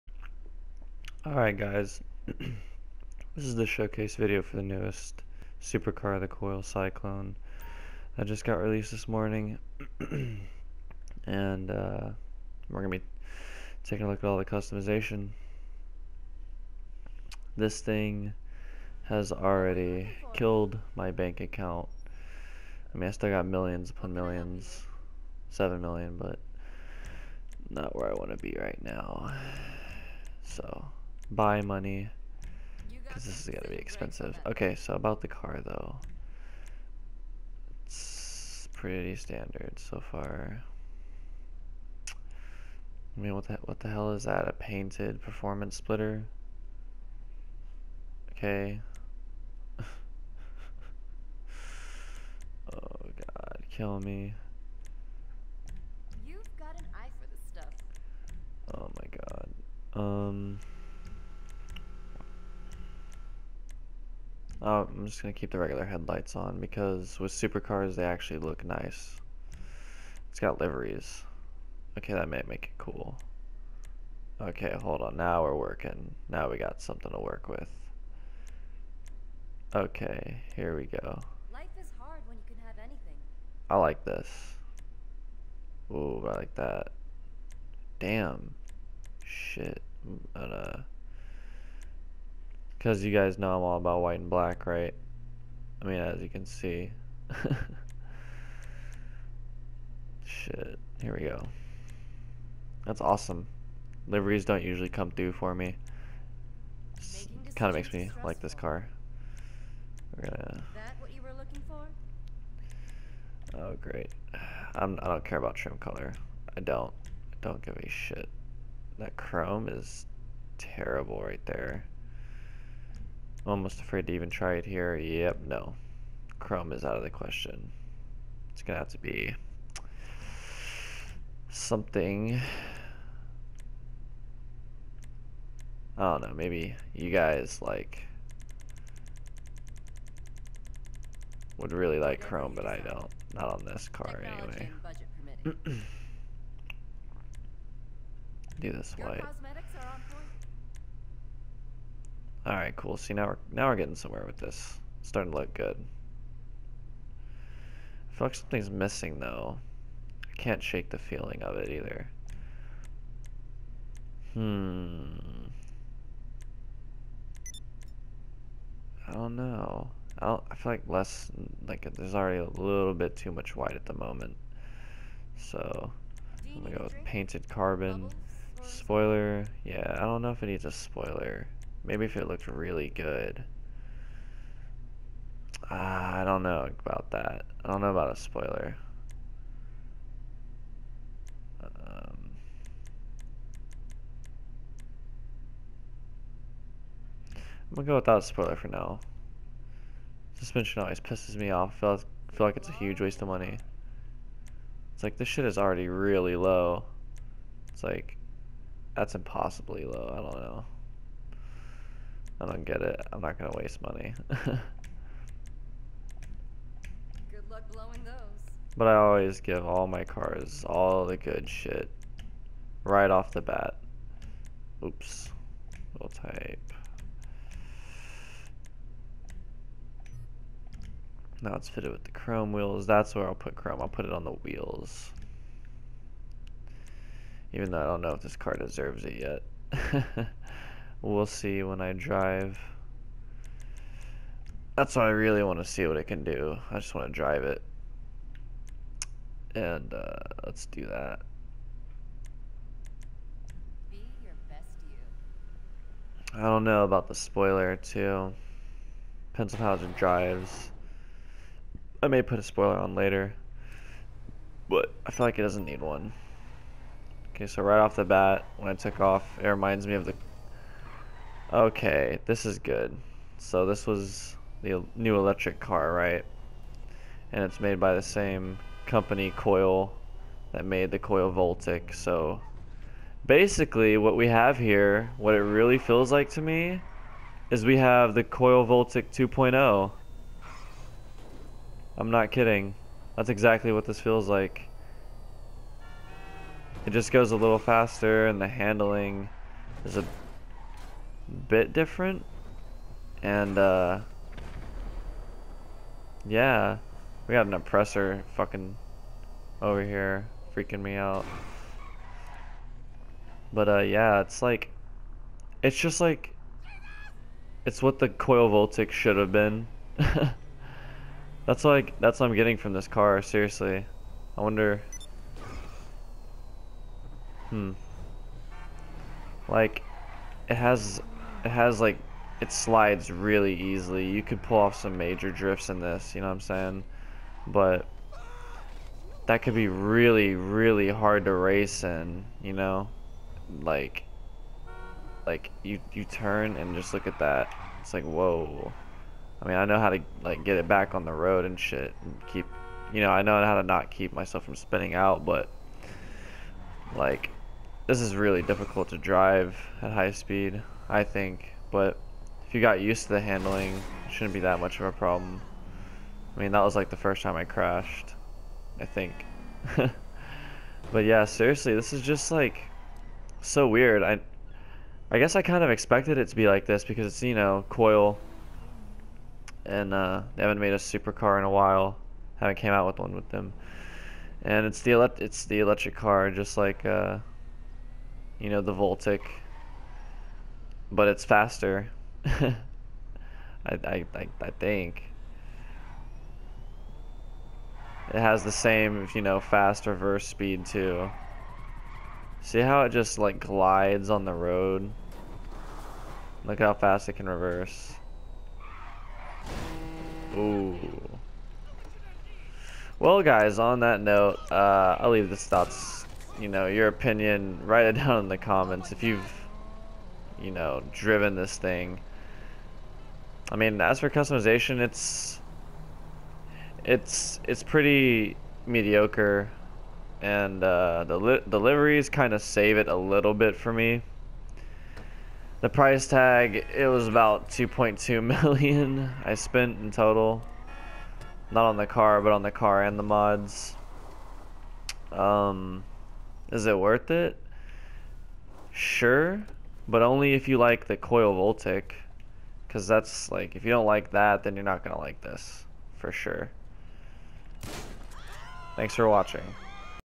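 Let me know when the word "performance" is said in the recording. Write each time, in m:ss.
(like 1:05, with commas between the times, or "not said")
0:45.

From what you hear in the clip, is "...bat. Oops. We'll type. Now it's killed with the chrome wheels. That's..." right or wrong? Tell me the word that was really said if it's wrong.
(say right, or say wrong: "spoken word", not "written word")
wrong: "fitted", not "killed".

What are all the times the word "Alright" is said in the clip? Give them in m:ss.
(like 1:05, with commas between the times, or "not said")
0:01.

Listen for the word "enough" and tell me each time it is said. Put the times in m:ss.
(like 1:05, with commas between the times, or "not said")
not said.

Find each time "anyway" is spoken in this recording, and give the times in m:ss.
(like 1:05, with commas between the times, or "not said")
2:24.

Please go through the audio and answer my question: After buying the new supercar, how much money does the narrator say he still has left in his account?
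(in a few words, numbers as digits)
7 million.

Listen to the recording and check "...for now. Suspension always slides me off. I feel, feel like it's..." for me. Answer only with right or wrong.
wrong.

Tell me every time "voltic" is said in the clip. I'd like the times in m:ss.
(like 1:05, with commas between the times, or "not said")
4:41, 4:48, 5:18, 6:28, 7:31.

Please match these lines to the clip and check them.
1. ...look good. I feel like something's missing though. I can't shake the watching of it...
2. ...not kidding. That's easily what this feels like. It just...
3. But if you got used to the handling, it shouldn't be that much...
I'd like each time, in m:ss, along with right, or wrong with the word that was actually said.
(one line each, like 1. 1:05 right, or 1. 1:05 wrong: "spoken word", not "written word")
1. 2:35 wrong: "feeling", not "watching"
2. 4:52 wrong: "exactly", not "easily"
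3. 6:01 right.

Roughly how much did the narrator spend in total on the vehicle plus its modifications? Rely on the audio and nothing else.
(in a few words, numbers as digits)
2.2 million.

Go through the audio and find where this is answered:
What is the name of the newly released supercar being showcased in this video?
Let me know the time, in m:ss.
0:06.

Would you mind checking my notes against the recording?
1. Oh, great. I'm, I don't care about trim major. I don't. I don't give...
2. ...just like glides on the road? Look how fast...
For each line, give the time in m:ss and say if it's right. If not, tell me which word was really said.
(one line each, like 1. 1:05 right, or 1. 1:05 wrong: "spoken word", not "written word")
1. 1:53 wrong: "color", not "major"
2. 6:42 right.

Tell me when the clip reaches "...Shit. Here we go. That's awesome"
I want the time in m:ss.
1:40.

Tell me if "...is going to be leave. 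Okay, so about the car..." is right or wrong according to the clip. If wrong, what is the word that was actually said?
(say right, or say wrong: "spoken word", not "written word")
wrong: "expensive", not "leave".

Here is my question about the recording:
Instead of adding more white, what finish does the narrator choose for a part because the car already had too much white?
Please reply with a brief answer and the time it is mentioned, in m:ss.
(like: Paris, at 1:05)
painted carbon, at 2:57.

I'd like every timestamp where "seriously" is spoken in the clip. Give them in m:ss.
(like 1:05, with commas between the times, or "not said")
5:23, 6:11.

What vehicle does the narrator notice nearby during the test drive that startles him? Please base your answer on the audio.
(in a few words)
an oppressor.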